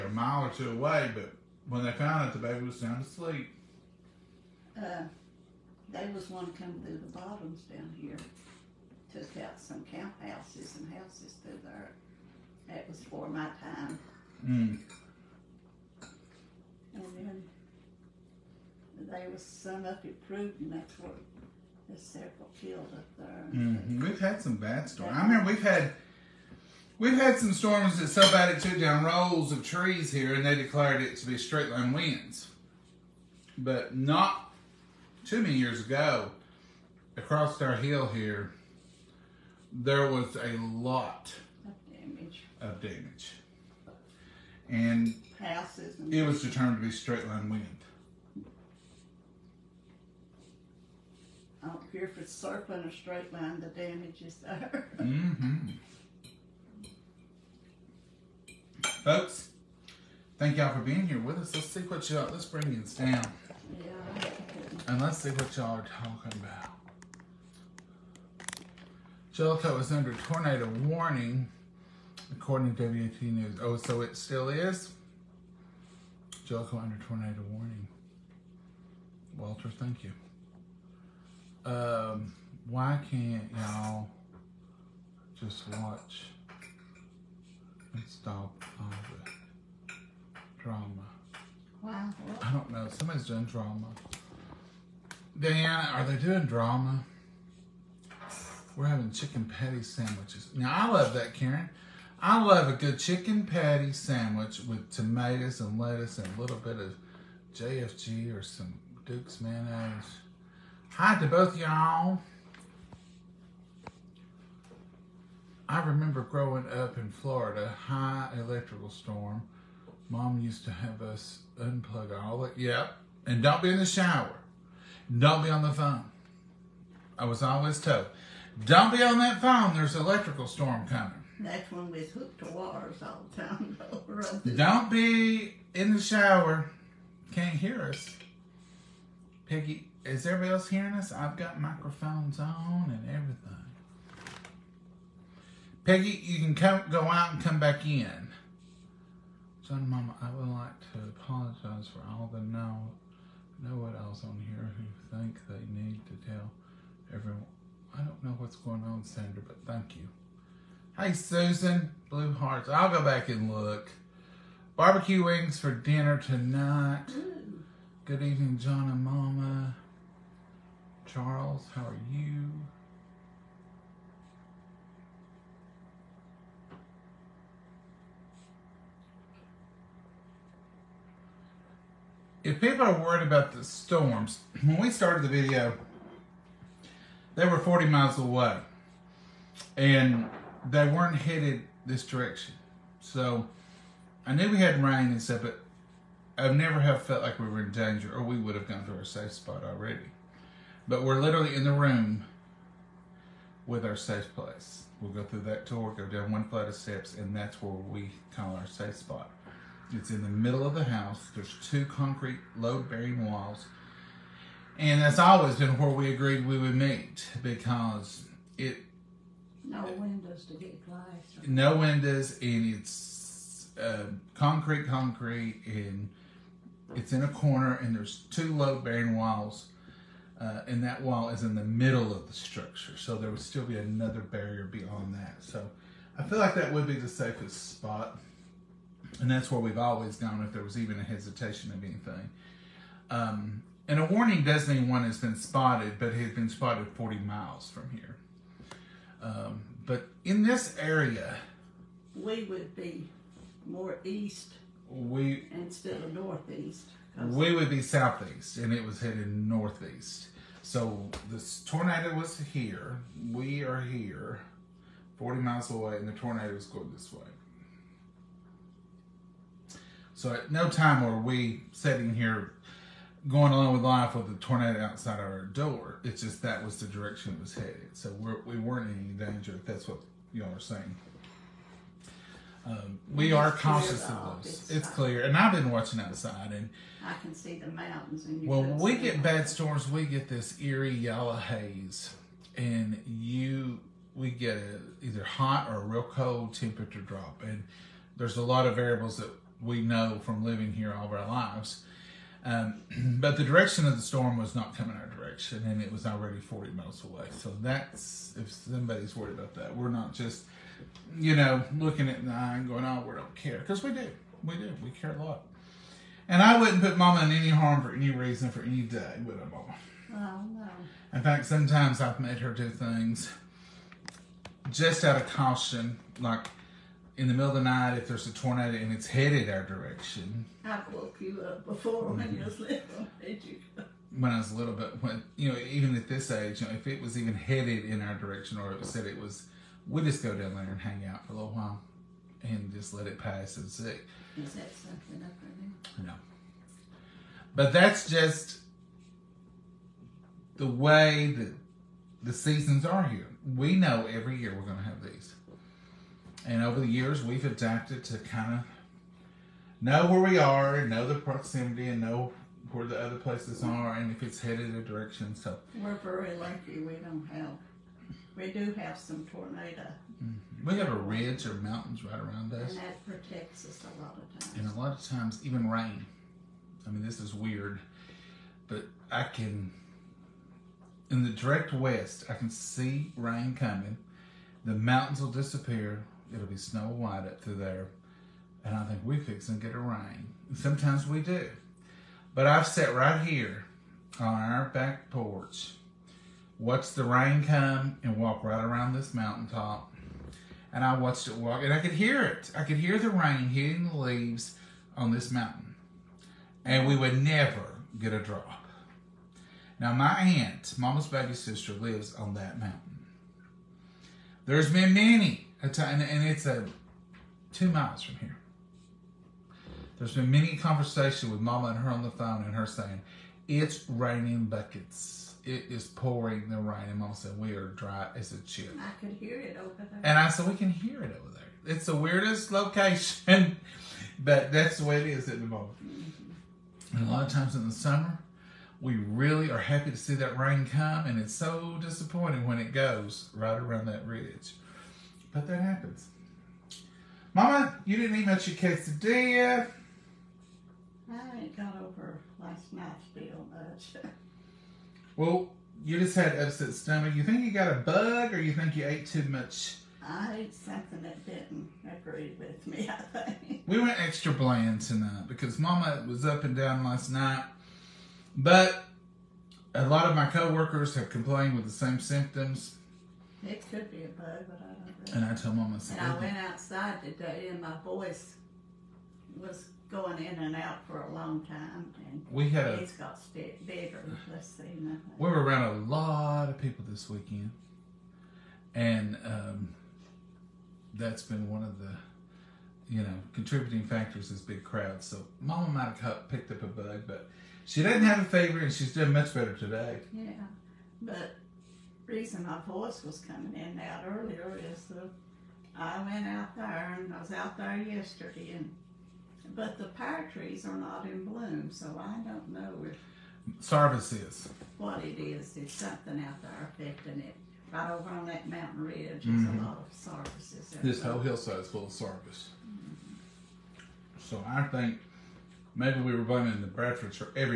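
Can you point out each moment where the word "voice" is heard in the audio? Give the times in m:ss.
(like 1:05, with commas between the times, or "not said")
7:57, 8:22.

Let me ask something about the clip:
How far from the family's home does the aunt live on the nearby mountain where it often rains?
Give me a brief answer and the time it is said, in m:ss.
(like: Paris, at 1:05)
2 miles, at 6:57.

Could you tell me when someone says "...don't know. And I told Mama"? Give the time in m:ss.
7:54.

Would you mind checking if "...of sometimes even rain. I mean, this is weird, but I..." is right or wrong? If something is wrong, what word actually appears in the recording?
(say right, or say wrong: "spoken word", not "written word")
wrong: "times", not "sometimes".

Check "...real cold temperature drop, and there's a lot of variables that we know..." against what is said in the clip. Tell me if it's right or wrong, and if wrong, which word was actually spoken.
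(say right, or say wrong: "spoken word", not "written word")
right.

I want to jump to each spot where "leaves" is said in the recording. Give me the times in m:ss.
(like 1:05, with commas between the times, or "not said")
6:43.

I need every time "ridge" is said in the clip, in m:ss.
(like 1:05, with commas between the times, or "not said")
6:10, 7:24, 8:38.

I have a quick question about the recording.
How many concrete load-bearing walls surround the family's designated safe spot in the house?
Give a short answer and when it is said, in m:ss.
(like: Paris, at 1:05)
2, at 3:31.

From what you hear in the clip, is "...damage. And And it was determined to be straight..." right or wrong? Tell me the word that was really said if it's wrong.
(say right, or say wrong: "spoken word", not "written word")
right.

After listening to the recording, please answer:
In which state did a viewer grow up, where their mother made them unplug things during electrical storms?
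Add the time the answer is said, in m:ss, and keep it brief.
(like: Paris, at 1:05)
Florida, at 1:56.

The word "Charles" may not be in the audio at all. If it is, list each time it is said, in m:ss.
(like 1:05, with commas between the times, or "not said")
2:51.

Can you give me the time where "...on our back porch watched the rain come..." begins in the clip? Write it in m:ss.
6:34.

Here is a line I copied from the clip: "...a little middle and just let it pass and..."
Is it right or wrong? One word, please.
wrong.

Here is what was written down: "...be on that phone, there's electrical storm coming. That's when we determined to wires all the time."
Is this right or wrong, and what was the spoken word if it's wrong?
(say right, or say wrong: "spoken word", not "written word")
wrong: "hooked", not "determined".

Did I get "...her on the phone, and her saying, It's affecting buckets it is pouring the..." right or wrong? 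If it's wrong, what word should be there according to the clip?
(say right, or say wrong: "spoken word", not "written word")
wrong: "raining", not "affecting".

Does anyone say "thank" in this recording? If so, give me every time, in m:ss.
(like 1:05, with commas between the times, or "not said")
1:00, 1:19, 2:39.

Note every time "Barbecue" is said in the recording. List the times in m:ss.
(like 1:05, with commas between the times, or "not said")
2:44.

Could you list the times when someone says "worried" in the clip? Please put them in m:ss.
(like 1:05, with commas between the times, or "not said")
3:02, 5:09.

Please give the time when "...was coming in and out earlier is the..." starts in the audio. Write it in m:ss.
8:23.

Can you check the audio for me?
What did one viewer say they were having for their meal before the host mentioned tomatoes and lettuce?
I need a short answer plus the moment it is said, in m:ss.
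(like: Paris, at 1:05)
Chicken patty sandwiches, at 1:39.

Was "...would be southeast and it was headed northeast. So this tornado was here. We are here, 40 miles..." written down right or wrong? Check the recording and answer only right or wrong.
right.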